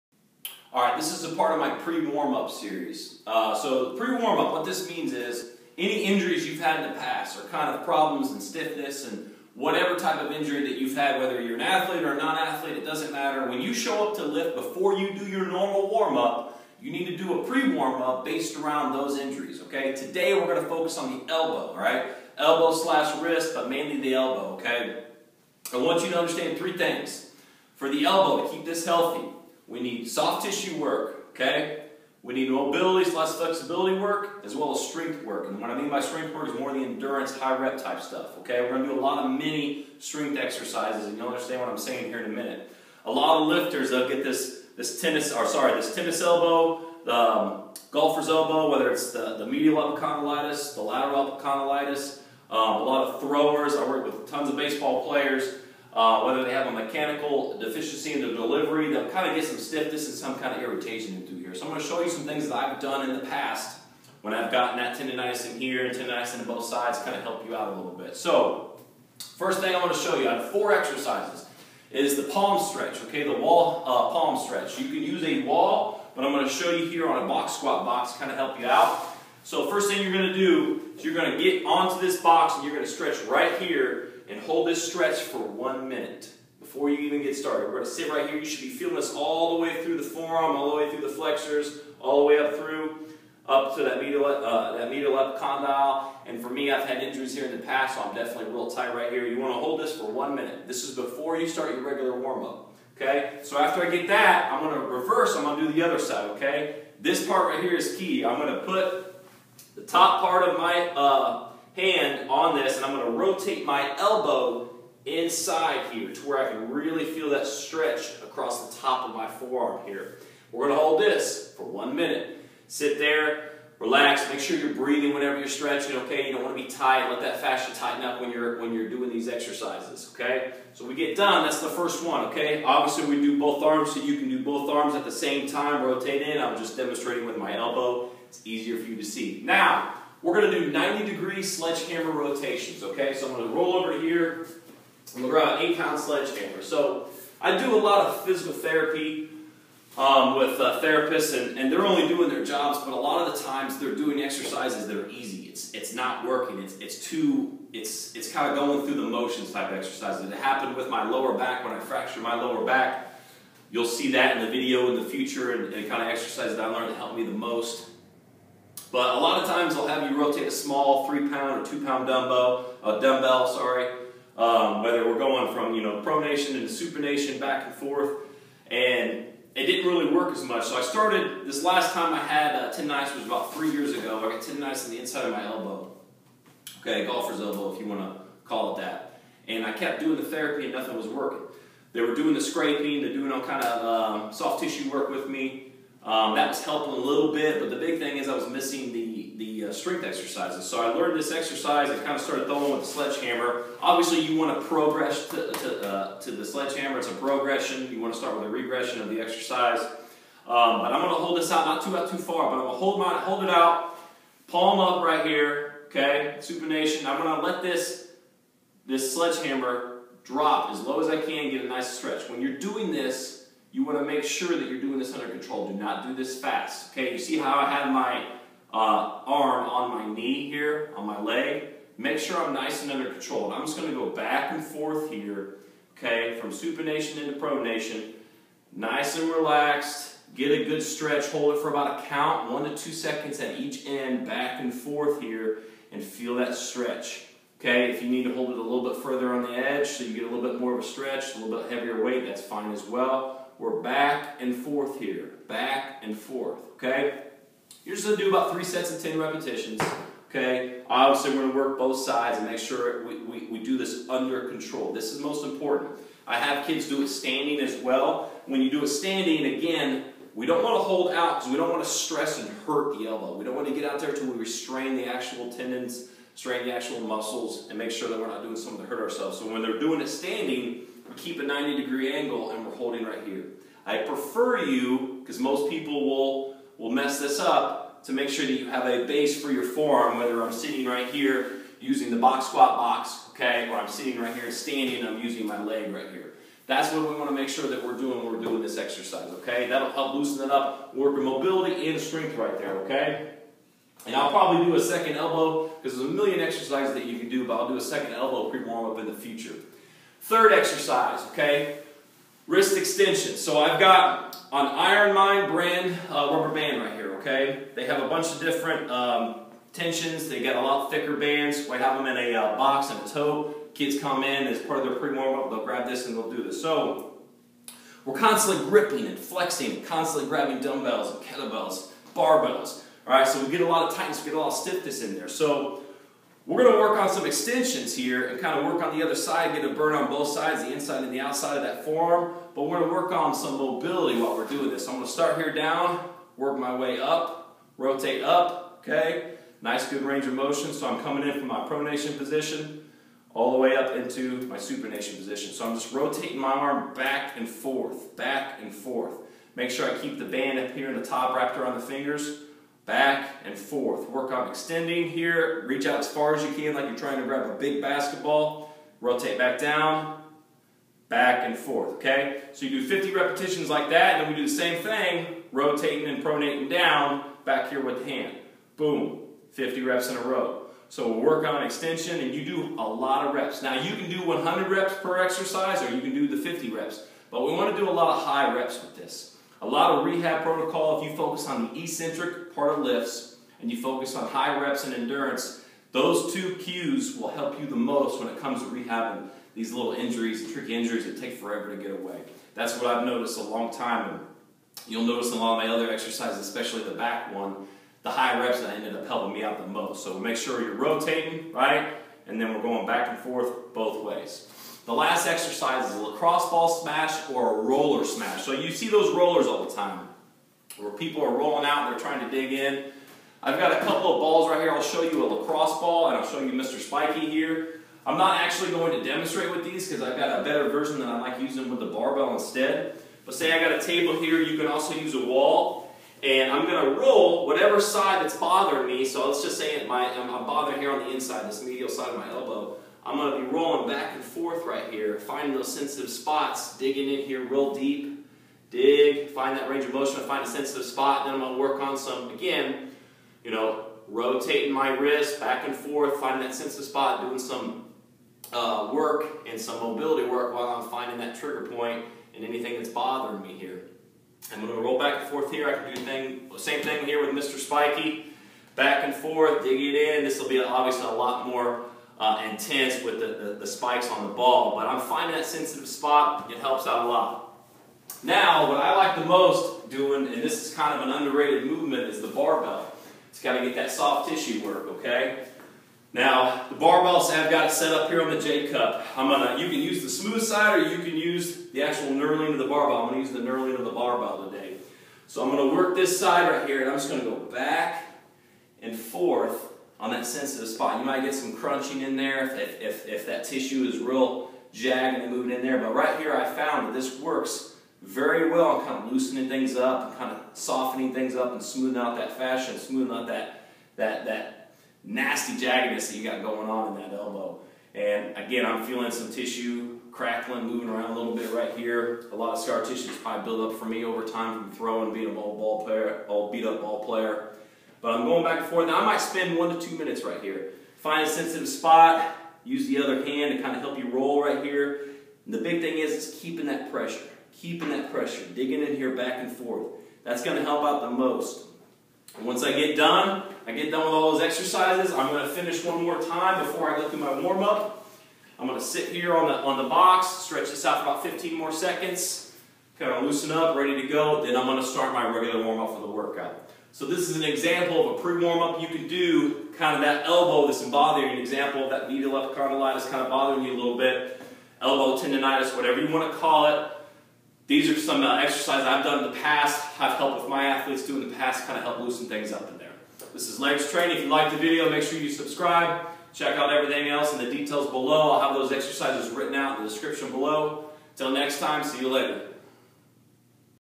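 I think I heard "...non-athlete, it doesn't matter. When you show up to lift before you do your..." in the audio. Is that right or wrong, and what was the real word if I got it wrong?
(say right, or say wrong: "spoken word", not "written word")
right.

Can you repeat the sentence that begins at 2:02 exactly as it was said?
Sit there, relax, make sure you're breathing whenever you're stretching, okay?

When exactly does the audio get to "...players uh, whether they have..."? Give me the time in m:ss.
0:55.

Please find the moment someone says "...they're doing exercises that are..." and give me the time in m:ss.
2:33.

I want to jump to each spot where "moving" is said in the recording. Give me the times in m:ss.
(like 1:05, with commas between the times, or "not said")
8:25, 8:40.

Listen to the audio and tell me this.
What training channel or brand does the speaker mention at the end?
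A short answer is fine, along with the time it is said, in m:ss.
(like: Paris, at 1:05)
Laird's Training, at 9:33.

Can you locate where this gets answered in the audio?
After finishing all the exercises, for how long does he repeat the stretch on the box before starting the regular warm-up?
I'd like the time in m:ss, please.
9:11.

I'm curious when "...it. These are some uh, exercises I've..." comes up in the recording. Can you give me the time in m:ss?
9:26.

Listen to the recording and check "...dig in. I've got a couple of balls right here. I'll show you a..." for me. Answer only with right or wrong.
right.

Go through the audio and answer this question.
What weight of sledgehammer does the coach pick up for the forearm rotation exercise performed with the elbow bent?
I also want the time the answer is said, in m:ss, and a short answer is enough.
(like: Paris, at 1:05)
8 pounds, at 2:25.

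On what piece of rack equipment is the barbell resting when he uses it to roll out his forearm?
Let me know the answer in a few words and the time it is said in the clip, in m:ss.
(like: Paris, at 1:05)
J-cup, at 8:08.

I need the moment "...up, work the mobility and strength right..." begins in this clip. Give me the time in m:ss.
5:00.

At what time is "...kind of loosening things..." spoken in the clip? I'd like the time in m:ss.
8:28.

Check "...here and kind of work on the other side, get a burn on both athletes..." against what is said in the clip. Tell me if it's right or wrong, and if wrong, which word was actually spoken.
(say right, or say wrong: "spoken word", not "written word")
wrong: "sides", not "athletes".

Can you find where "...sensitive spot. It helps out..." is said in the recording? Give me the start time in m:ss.
7:55.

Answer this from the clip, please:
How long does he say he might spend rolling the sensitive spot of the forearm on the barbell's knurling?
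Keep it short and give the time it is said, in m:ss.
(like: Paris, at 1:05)
1 to 2 minutes, at 8:49.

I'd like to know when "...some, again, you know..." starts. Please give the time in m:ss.
7:31.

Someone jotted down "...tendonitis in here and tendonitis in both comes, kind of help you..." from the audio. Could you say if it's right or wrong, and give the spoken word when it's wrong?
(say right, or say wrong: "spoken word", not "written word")
wrong: "sides", not "comes".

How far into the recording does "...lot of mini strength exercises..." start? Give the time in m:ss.
0:38.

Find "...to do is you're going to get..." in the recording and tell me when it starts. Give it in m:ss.
1:20.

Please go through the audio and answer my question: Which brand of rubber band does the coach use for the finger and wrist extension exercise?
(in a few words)
IronMind.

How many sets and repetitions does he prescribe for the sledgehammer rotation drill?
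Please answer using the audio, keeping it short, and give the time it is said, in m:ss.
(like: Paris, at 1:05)
3 sets of 10, at 4:18.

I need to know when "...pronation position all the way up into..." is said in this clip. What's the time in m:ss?
5:51.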